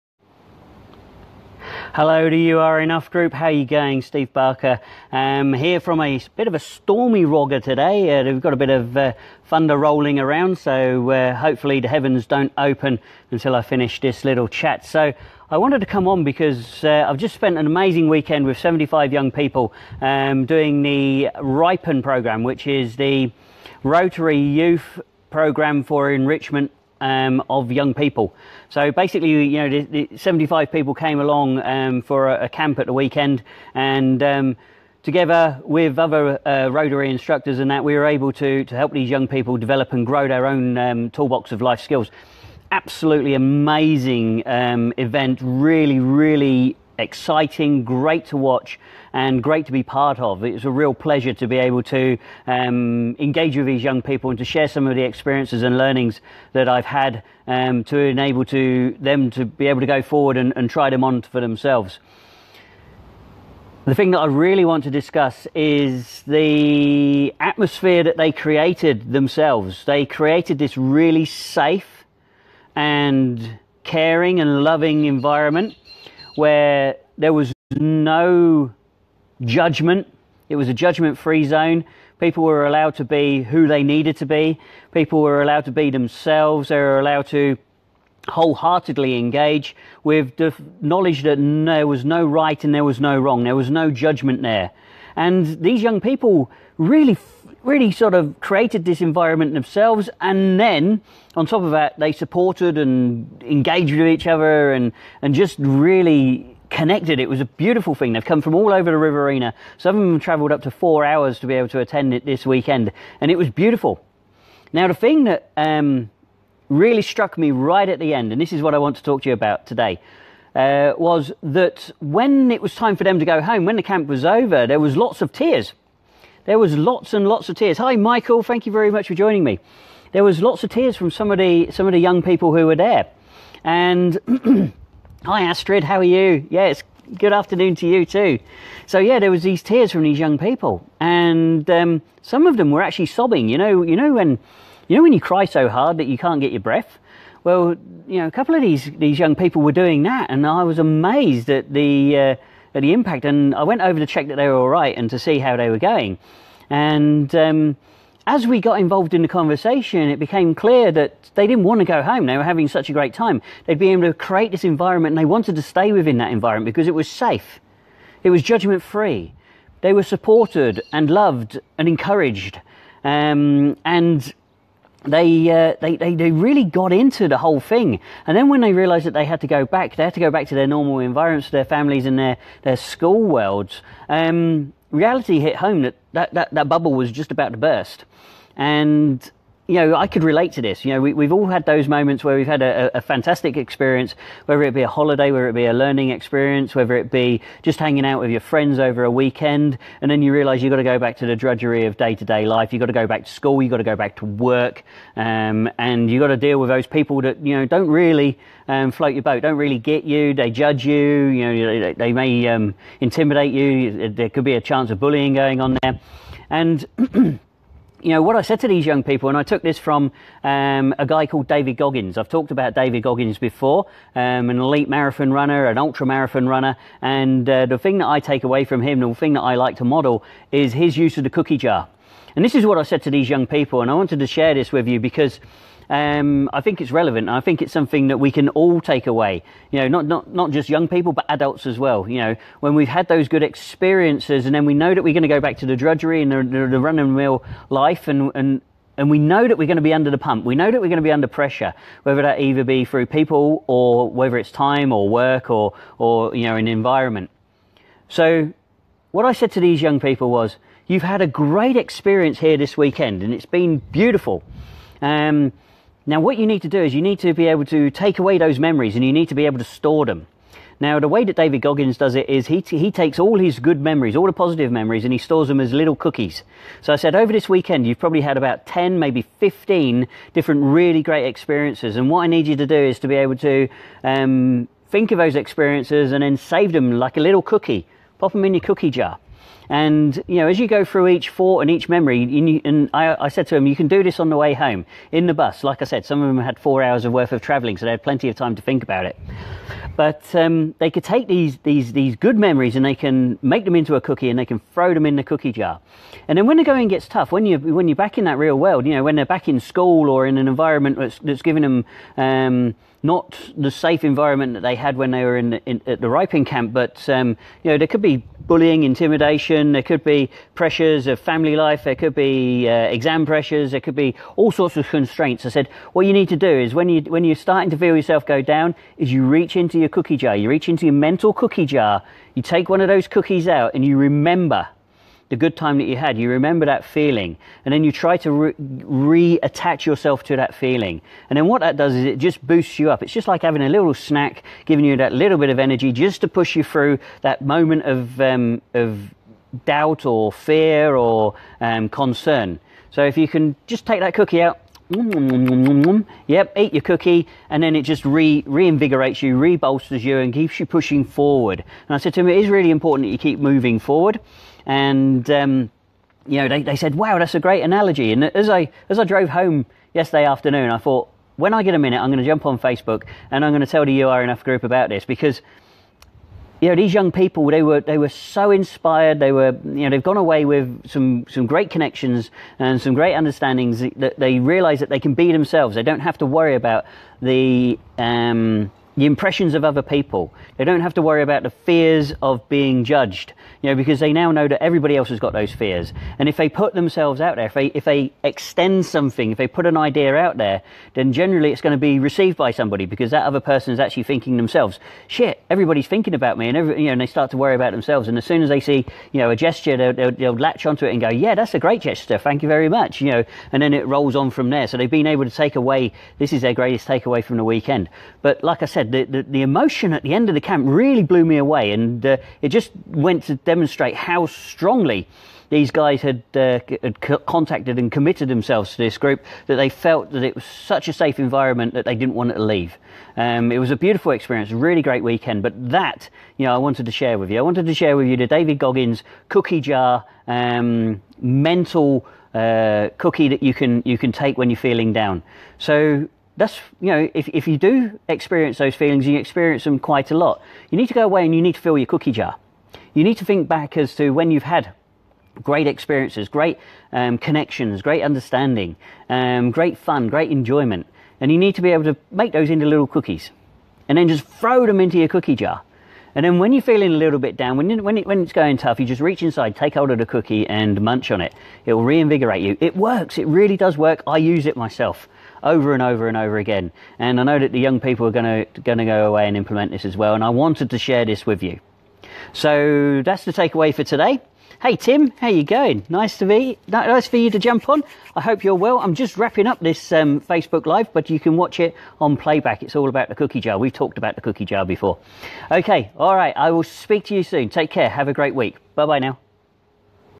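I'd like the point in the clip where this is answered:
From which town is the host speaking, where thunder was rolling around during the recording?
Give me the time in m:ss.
0:07.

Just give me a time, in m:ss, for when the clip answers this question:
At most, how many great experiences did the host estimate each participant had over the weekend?
4:39.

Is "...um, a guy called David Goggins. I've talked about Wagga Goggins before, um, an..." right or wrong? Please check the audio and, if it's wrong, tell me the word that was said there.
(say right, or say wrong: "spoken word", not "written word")
wrong: "David", not "Wagga".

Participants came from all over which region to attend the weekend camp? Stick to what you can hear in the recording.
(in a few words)
The Riverina.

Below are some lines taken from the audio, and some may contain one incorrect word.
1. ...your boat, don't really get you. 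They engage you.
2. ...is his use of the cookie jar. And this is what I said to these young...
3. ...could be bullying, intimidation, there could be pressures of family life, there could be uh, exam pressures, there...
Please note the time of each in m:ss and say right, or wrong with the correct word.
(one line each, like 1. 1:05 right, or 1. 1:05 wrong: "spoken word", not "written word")
1. 3:29 wrong: "judge", not "engage"
2. 3:50 right
3. 5:17 right.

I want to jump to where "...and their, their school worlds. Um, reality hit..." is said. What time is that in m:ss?
3:02.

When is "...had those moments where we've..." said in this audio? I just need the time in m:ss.
3:11.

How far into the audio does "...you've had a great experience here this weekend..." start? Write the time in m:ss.
4:20.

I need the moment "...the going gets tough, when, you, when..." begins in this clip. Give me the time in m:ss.
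5:06.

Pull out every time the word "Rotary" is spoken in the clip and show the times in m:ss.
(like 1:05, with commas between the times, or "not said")
0:23, 0:36.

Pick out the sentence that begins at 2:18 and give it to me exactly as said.
So yeah, there was these tears from these young people, and um, some of them were actually sobbing.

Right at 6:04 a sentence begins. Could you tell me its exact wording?
And um, you know, they, they said, wow, that's a great analogy.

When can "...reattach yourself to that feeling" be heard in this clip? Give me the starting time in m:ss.
5:39.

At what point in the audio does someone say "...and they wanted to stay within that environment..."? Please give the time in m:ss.
2:45.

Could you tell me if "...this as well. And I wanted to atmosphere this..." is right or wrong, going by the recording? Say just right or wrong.
wrong.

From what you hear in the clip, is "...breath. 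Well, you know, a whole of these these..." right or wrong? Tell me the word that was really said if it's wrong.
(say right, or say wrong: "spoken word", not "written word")
wrong: "couple", not "whole".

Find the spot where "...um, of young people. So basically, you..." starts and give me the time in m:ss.
0:27.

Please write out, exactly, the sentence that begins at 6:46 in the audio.
And, every, you know, and they start to worry about themselves.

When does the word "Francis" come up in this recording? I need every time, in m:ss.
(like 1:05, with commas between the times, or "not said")
not said.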